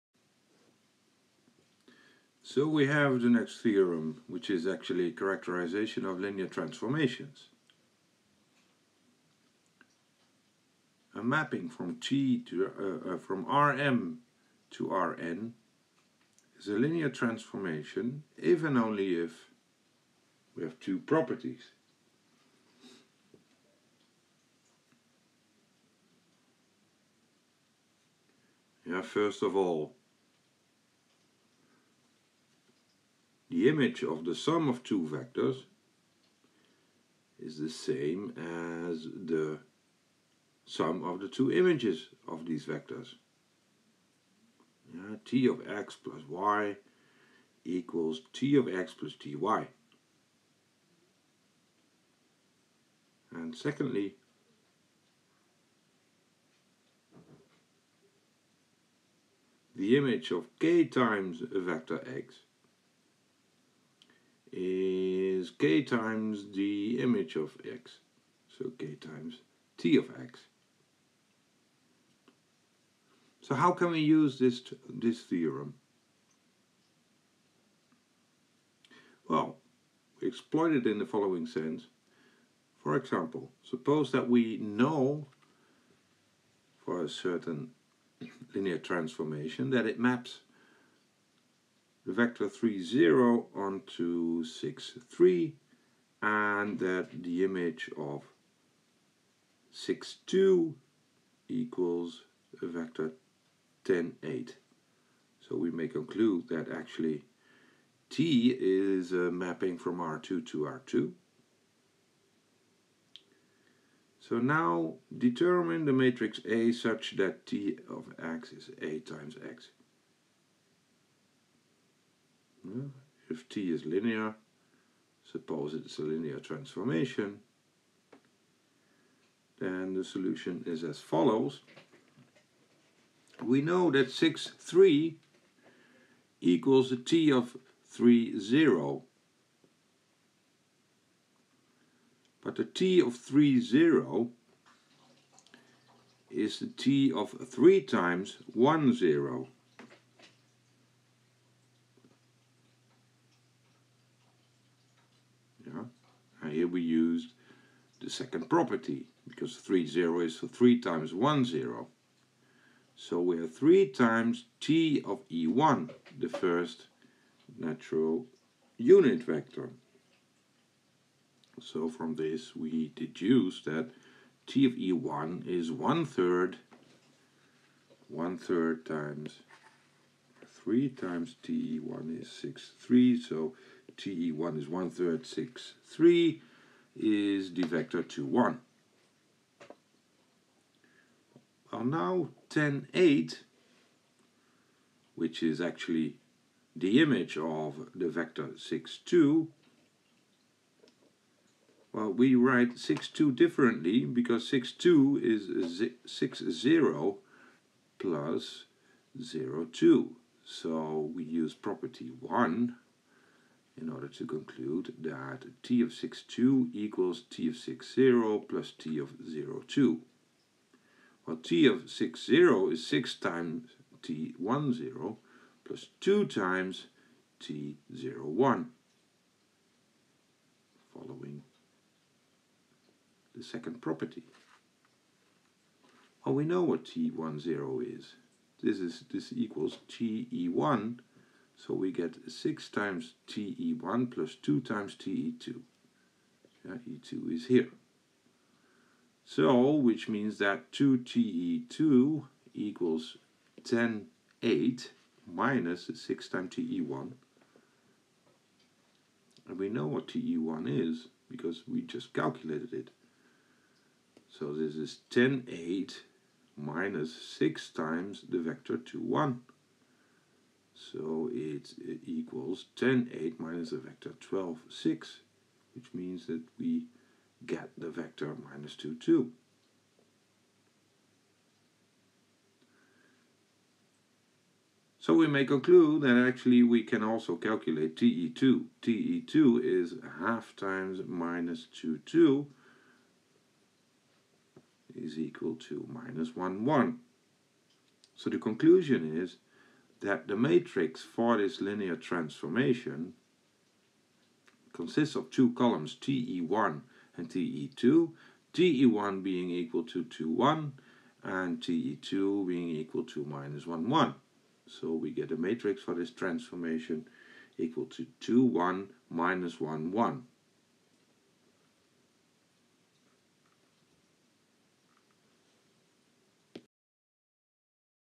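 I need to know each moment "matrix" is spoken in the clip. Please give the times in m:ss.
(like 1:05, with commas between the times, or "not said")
1:55, 5:00, 5:15.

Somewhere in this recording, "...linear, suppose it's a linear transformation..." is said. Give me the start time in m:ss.
2:03.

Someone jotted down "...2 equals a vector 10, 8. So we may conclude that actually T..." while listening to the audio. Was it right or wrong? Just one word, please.
right.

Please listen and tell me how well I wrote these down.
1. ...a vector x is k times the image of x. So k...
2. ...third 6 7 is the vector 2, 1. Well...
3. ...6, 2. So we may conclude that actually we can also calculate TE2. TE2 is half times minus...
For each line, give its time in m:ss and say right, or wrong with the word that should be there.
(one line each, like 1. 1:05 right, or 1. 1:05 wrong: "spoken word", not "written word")
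1. 1:01 right
2. 3:04 wrong: "3", not "7"
3. 4:38 wrong: "2", not "6".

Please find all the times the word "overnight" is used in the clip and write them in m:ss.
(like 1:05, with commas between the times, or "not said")
not said.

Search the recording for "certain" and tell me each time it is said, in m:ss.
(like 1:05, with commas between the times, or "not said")
1:27.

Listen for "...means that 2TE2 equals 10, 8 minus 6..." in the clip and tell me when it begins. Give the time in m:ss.
4:10.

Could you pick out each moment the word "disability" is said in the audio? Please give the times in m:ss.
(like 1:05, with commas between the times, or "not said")
not said.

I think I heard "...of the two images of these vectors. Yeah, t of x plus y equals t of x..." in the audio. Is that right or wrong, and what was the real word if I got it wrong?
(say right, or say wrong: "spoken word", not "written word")
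right.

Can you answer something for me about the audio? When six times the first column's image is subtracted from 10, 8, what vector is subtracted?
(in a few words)
12, 6.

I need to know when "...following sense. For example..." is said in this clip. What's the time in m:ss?
1:21.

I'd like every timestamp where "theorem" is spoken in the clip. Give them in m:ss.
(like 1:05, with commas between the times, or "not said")
0:03, 1:15.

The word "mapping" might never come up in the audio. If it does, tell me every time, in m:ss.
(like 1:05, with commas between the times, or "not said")
0:11, 1:49.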